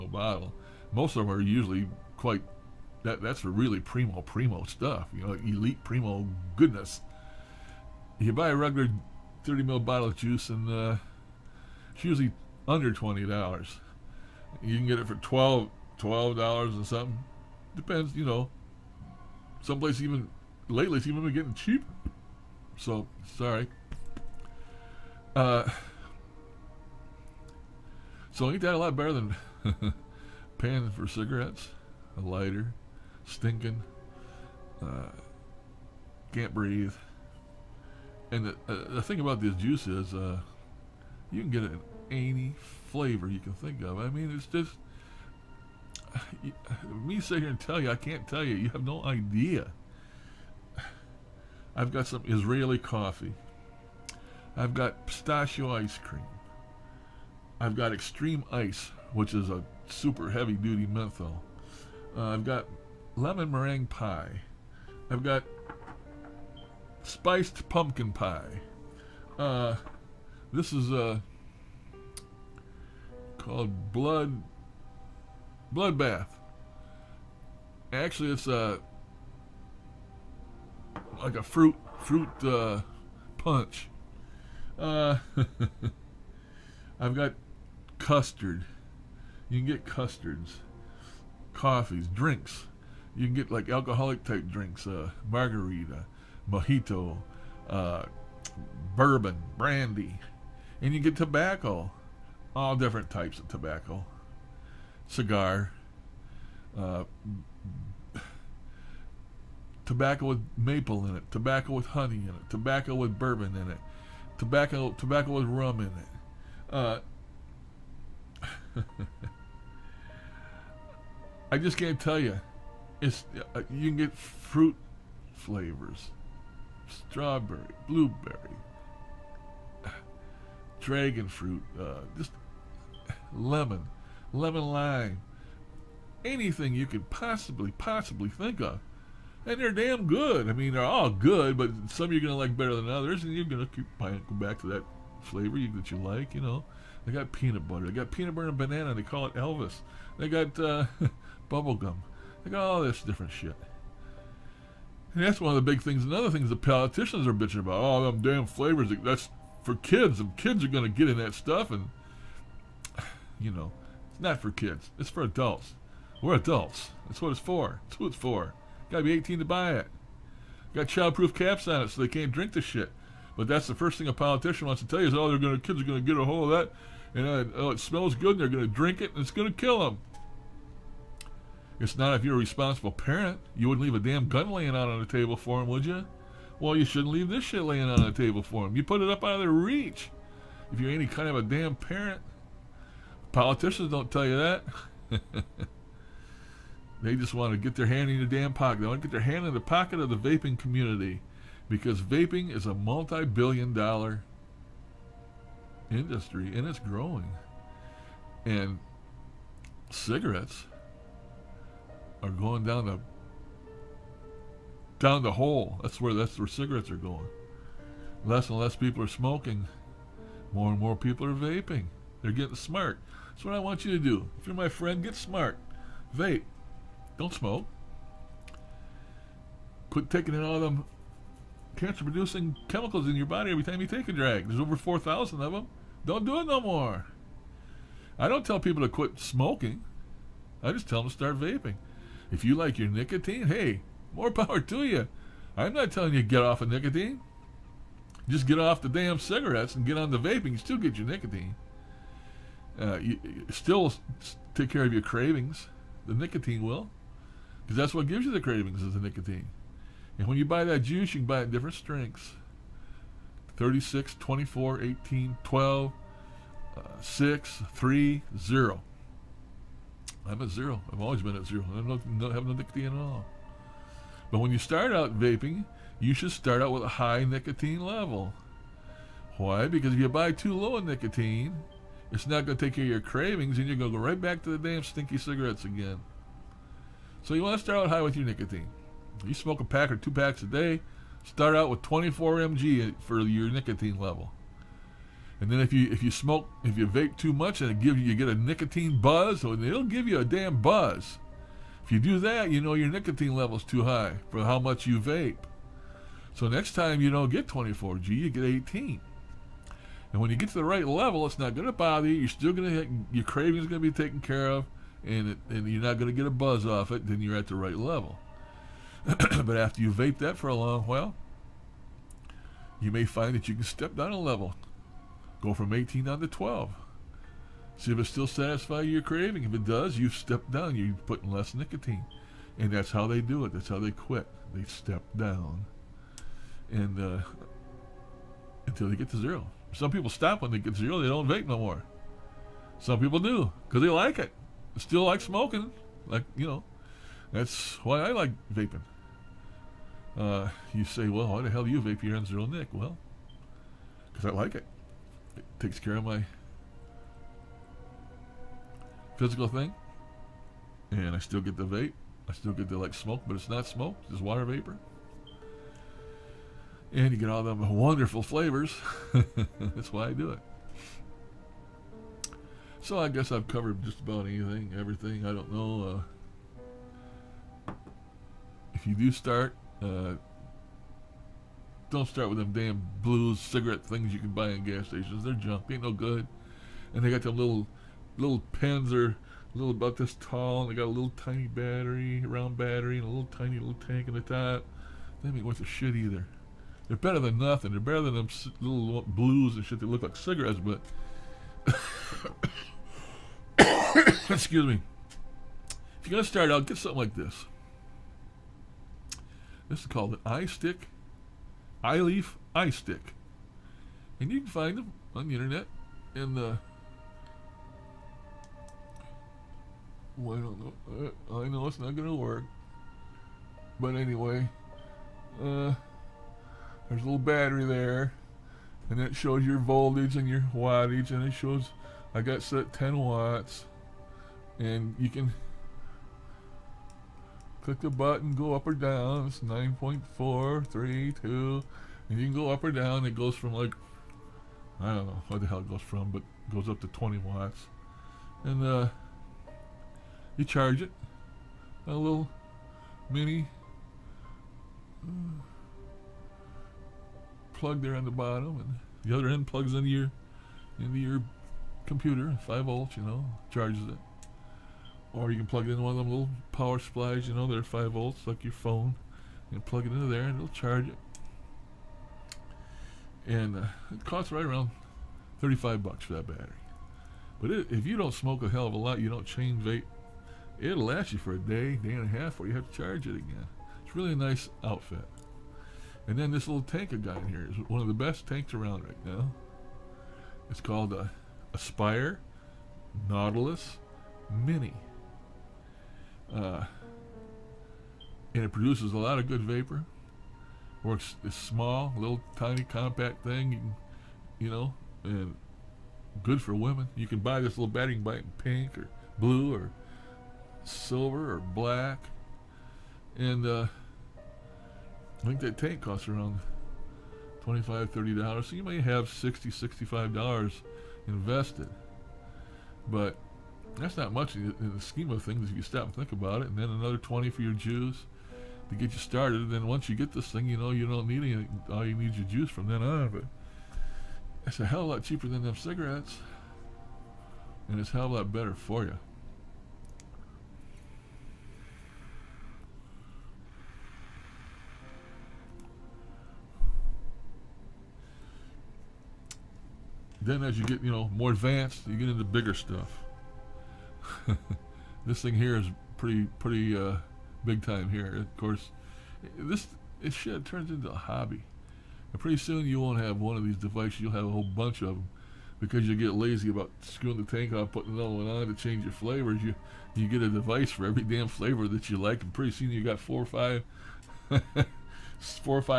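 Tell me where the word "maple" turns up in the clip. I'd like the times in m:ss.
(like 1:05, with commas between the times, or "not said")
1:50.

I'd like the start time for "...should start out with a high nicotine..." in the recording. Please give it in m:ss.
4:36.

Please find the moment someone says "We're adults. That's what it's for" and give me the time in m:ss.
2:46.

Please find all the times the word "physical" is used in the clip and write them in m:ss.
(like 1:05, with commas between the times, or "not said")
5:59.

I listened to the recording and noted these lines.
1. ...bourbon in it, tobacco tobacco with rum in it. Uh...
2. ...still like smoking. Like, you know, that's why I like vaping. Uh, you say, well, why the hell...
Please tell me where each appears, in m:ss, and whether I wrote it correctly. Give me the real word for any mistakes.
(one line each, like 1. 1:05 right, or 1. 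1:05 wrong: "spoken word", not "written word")
1. 1:53 right
2. 5:44 right.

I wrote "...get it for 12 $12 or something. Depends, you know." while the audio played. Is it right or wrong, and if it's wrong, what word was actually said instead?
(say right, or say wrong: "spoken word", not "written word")
right.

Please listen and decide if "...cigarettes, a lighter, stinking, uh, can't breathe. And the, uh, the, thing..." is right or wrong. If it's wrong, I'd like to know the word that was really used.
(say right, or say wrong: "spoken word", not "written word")
right.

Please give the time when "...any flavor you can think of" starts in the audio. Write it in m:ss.
0:42.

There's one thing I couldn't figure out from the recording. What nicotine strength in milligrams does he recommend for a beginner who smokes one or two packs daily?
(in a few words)
24 mg.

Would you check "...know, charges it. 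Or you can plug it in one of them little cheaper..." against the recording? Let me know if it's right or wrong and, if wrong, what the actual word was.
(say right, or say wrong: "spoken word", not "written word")
wrong: "power", not "cheaper".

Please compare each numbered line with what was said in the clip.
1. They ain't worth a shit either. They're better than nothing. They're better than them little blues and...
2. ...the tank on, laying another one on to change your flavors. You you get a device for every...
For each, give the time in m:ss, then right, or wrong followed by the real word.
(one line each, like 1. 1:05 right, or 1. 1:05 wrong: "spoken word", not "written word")
1. 6:35 right
2. 9:27 wrong: "putting", not "laying".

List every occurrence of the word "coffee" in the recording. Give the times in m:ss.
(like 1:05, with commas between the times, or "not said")
0:52, 1:31.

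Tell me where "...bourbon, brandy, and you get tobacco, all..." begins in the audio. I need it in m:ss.
1:38.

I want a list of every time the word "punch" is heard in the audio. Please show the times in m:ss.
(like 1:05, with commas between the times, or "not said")
1:23.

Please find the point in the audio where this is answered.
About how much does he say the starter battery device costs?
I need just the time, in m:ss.
7:55.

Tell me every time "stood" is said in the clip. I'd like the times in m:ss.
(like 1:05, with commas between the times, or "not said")
not said.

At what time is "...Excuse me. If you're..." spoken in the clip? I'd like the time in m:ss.
6:44.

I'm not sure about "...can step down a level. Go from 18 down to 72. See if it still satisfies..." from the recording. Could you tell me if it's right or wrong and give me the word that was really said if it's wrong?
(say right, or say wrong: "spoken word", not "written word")
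wrong: "12", not "72".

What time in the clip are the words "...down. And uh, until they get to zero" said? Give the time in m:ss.
5:35.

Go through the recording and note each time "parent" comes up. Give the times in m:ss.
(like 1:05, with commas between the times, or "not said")
3:02, 3:11.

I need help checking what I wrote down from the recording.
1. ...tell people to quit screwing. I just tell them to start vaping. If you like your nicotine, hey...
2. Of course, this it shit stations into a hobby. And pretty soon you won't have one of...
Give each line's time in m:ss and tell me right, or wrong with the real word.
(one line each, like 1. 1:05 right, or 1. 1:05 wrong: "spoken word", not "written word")
1. 3:58 wrong: "smoking", not "screwing"
2. 9:18 wrong: "turns", not "stations".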